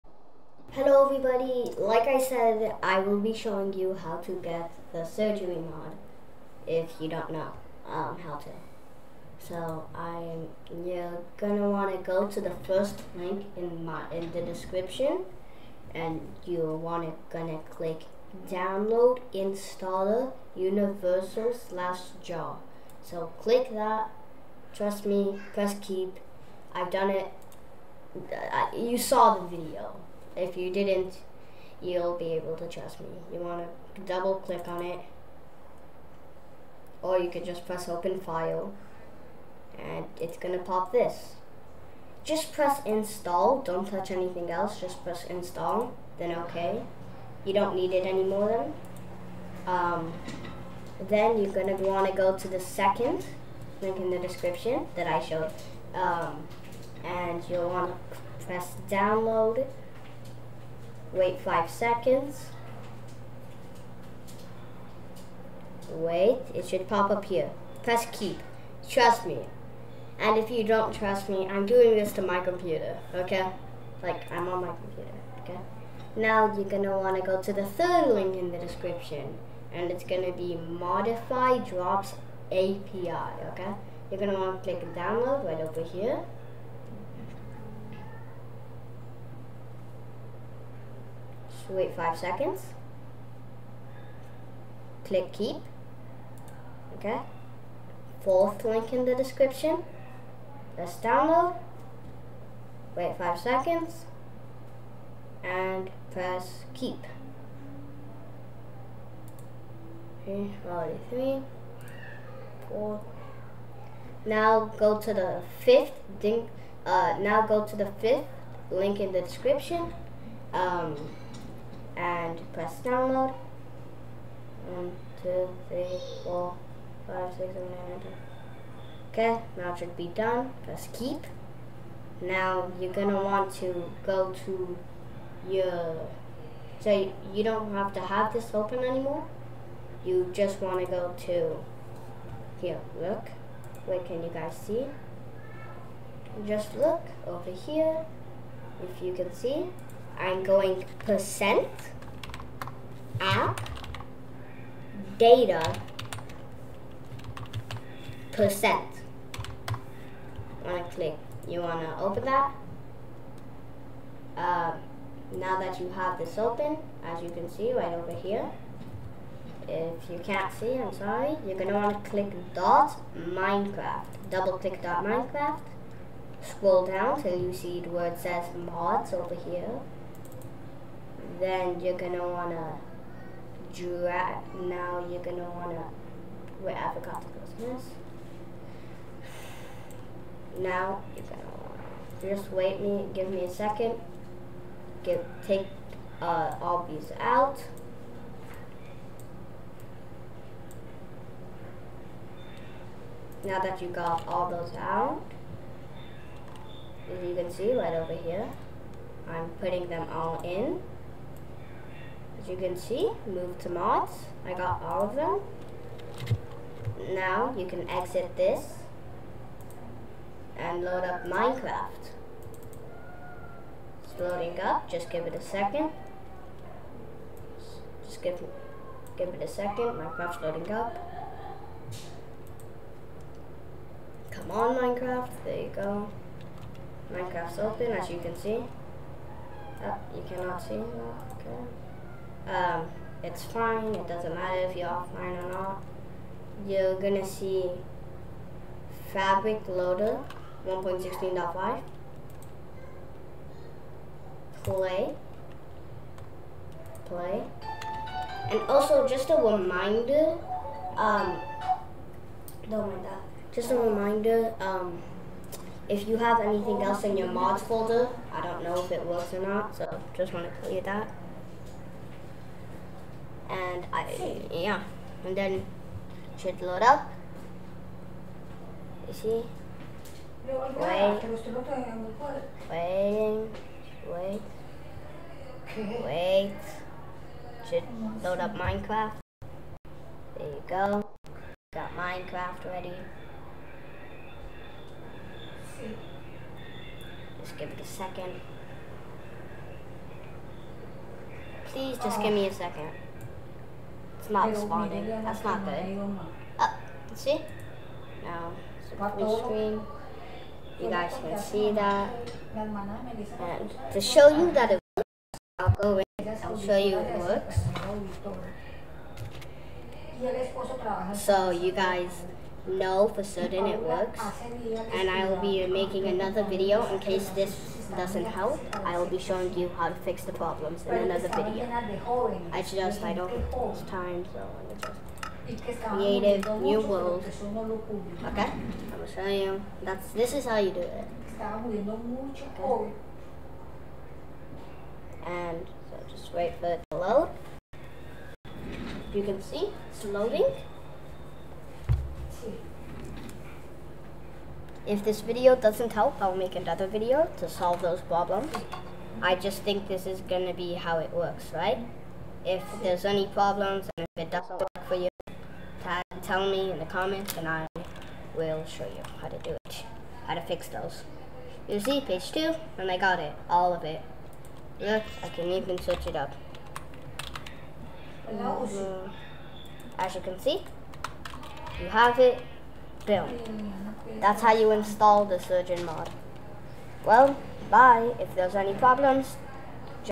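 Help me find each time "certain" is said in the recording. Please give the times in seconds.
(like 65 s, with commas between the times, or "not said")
323 s.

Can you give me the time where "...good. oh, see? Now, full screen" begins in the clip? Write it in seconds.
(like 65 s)
305 s.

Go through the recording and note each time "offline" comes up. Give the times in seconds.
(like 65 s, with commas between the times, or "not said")
244 s.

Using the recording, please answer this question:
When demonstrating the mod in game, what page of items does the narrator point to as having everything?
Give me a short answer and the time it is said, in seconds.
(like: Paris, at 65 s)
Page 2, at 372 s.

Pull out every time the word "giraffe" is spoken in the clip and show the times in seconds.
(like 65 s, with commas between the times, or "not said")
183 s.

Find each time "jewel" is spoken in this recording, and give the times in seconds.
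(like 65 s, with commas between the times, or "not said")
not said.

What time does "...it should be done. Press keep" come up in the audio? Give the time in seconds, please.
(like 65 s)
129 s.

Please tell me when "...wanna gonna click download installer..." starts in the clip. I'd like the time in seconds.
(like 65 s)
16 s.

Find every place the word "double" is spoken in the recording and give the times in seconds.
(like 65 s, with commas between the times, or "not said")
34 s, 174 s.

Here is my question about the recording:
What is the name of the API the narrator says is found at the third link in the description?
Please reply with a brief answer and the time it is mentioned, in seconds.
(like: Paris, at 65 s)
Modify Drops API, at 80 s.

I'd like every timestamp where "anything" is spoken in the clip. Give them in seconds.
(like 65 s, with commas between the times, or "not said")
44 s, 266 s.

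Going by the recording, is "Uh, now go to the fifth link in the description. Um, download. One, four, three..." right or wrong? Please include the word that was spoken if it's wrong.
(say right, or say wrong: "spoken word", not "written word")
wrong: "two", not "four".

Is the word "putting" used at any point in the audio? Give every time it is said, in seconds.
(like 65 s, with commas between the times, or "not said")
209 s.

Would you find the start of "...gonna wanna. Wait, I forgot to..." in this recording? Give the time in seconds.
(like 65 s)
185 s.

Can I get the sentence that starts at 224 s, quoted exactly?
It's loading up, just give it a second.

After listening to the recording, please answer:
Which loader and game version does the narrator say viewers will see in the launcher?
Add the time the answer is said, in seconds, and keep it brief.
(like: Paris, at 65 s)
Fabric Loader 1.16.5, at 249 s.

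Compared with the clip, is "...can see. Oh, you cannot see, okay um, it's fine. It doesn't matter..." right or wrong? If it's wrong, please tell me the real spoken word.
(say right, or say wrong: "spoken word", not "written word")
right.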